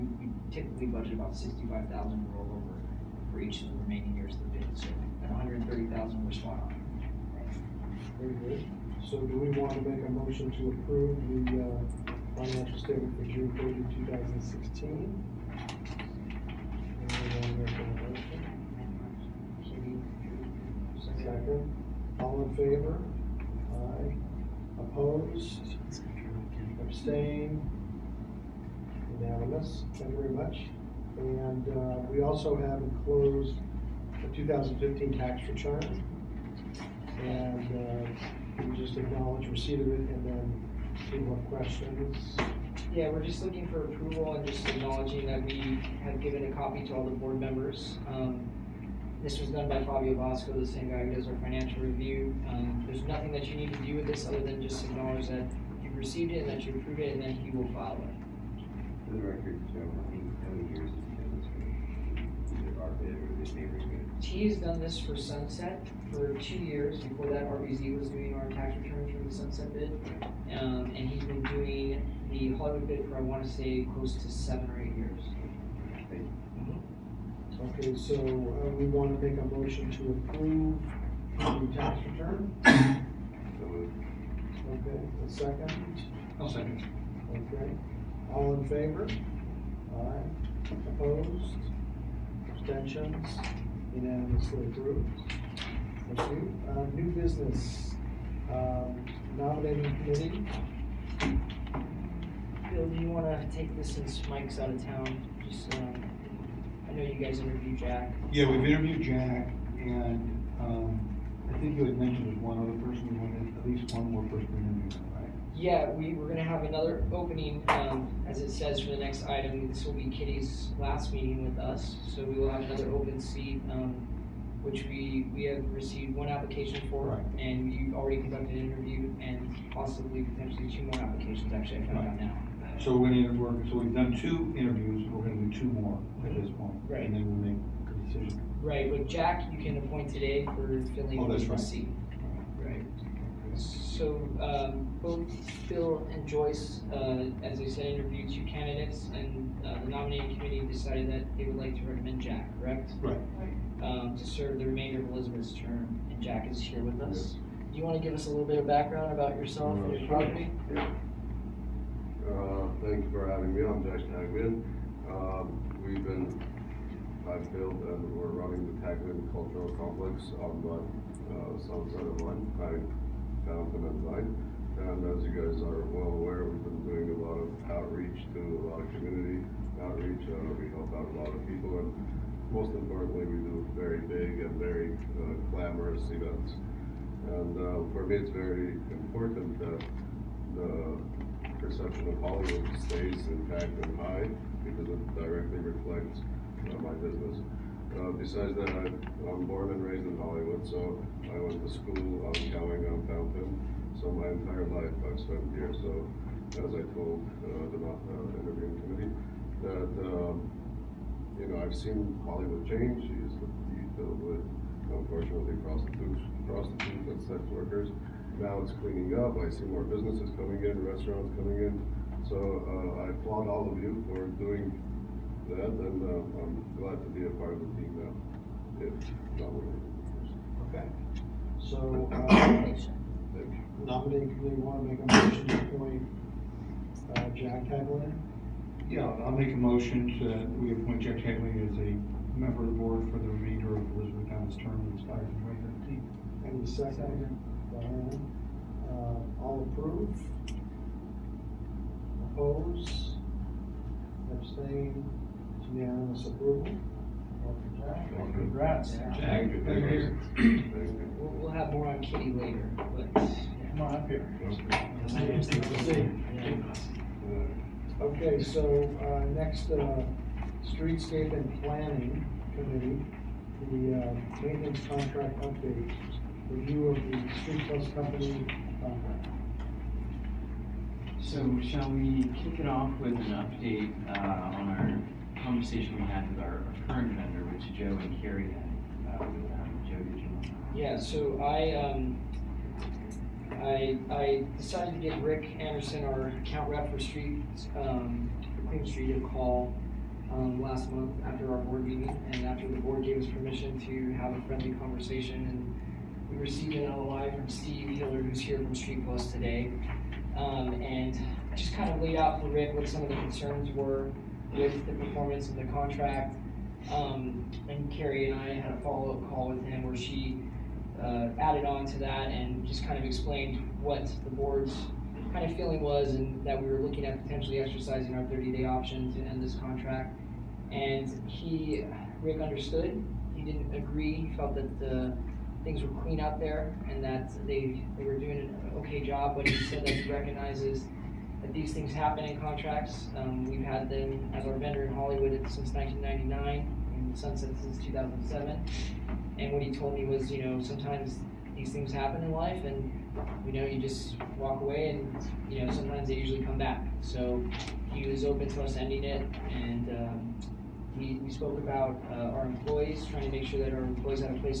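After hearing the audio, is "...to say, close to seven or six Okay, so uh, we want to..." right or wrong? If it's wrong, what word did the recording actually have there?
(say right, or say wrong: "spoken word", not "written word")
wrong: "eight", not "six".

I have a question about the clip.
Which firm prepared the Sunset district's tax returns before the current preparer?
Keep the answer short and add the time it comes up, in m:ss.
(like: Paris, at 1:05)
RBZ, at 1:07.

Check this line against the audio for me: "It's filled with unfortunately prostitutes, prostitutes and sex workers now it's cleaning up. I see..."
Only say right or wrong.
right.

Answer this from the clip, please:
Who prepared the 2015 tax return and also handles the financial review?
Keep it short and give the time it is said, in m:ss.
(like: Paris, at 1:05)
Fabio Bosco, at 0:49.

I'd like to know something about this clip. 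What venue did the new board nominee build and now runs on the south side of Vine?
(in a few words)
Taglyan Cultural Complex.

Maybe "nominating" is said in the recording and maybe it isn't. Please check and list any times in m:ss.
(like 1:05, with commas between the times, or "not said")
1:39, 2:29, 3:53.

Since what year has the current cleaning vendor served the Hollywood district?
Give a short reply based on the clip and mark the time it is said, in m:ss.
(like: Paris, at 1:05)
1999, at 5:45.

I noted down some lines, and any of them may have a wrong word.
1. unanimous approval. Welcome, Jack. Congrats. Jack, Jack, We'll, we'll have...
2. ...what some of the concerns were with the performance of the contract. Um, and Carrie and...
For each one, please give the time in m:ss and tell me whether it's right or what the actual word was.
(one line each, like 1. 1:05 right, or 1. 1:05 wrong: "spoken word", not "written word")
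1. 4:15 right
2. 5:12 right.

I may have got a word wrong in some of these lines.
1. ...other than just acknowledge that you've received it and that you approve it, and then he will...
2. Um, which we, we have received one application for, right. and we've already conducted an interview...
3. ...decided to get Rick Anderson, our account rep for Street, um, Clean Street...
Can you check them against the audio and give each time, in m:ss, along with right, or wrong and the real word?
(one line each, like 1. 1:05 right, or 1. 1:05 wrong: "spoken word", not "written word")
1. 0:54 right
2. 2:03 right
3. 4:54 right.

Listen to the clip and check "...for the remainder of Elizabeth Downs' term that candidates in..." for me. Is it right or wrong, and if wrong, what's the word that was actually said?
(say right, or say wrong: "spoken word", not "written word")
wrong: "expires", not "candidates".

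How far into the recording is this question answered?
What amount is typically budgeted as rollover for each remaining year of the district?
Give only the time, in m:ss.
0:01.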